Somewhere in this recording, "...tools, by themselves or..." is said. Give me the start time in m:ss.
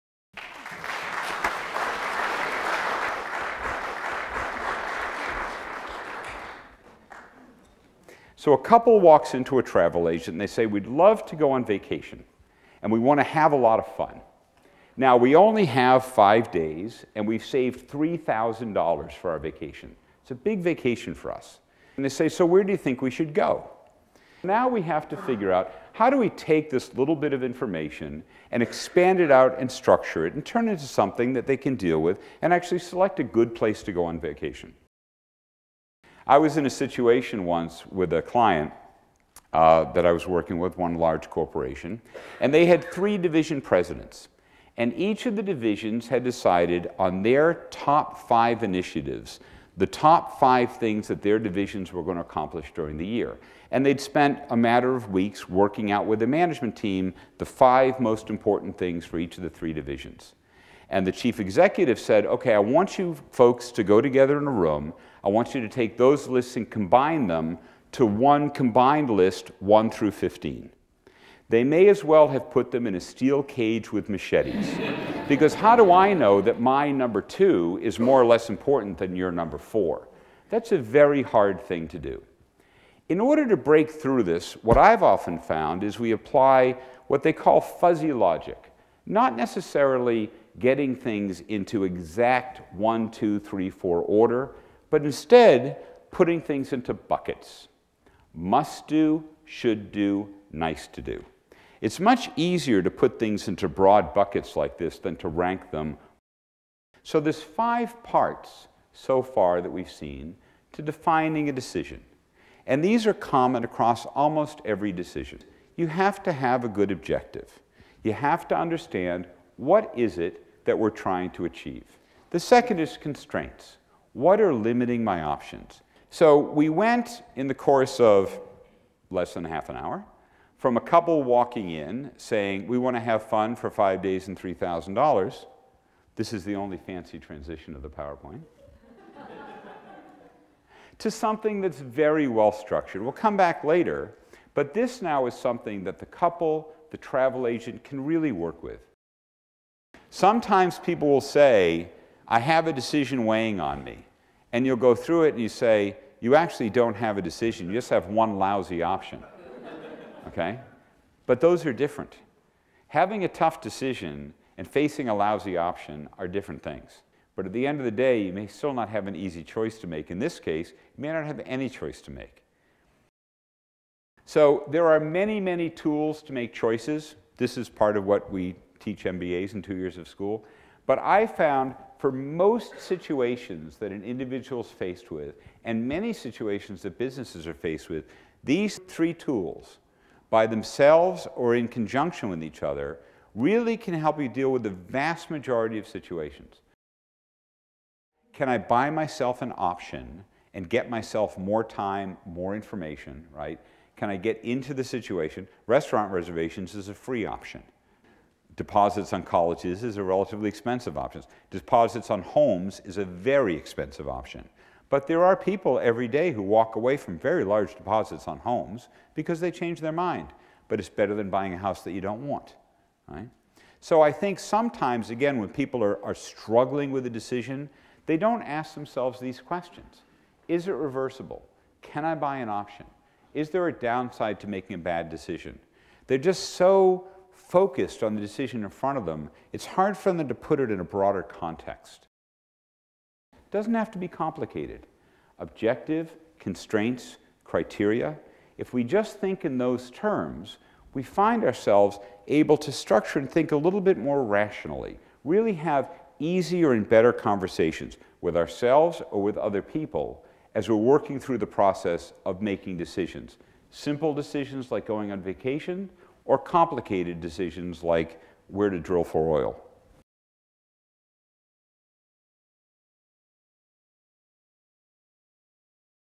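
3:09.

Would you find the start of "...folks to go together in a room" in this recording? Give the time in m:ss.
1:03.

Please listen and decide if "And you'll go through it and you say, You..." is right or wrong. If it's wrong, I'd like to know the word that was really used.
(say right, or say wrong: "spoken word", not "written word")
right.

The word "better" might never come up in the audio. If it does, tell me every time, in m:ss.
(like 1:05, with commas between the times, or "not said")
3:40, 4:16.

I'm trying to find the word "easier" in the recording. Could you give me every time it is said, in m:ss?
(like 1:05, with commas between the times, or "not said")
1:42, 4:16.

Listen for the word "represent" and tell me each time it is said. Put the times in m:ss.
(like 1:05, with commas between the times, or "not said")
not said.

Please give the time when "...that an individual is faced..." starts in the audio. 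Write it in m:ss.
3:03.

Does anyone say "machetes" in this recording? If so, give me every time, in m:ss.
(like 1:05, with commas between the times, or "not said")
1:14.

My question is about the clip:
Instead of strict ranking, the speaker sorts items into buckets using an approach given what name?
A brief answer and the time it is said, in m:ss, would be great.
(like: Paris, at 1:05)
fuzzy logic, at 1:27.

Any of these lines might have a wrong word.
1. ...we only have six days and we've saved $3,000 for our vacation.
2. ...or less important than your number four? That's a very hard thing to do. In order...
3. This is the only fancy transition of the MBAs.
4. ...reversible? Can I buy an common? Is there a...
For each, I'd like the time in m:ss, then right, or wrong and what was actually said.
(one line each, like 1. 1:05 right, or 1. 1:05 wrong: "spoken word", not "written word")
1. 0:15 wrong: "five", not "six"
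2. 1:18 right
3. 2:16 wrong: "PowerPoint", not "MBAs"
4. 3:50 wrong: "option", not "common".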